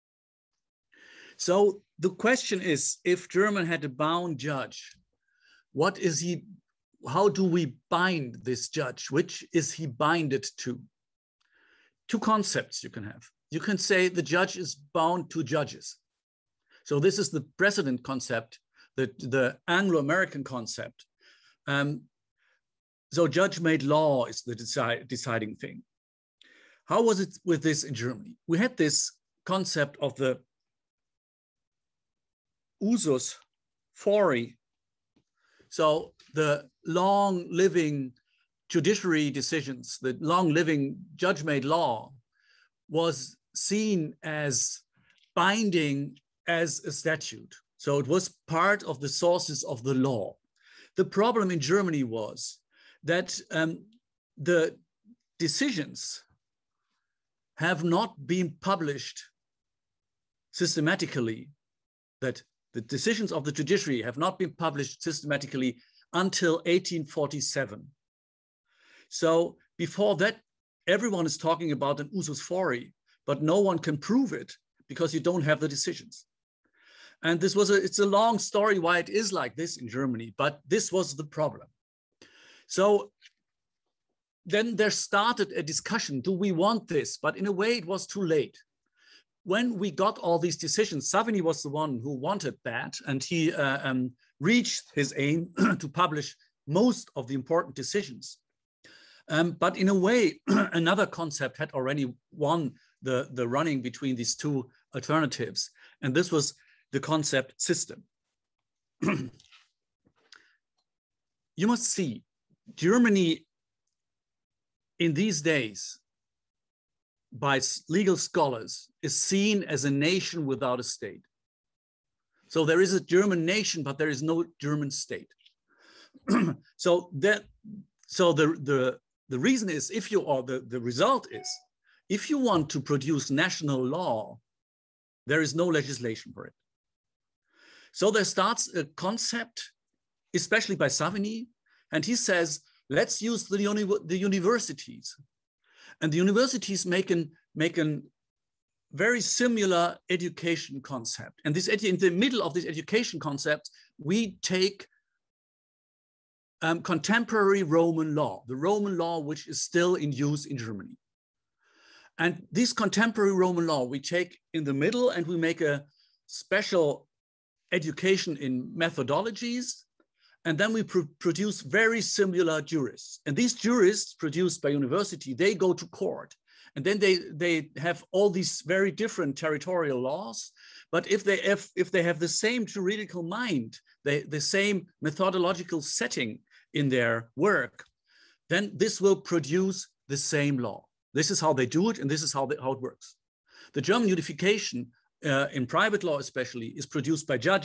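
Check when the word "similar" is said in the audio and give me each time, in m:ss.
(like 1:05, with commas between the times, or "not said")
2:29, 2:51.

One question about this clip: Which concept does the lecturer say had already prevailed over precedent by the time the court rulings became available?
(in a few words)
system.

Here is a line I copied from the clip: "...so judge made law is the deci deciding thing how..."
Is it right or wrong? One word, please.
right.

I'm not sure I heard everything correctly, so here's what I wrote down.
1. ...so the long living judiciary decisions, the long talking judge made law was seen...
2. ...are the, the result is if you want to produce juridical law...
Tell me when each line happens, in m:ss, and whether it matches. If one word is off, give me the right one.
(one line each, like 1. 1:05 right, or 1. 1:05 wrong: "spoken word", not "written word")
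1. 0:35 wrong: "living", not "talking"
2. 2:10 wrong: "national", not "juridical".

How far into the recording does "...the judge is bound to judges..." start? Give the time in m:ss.
0:14.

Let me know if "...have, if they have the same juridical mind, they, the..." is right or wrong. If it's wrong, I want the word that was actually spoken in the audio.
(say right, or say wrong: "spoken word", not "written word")
right.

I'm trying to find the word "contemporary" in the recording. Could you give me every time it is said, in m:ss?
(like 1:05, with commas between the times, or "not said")
2:36, 2:42.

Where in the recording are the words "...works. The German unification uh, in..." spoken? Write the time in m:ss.
3:12.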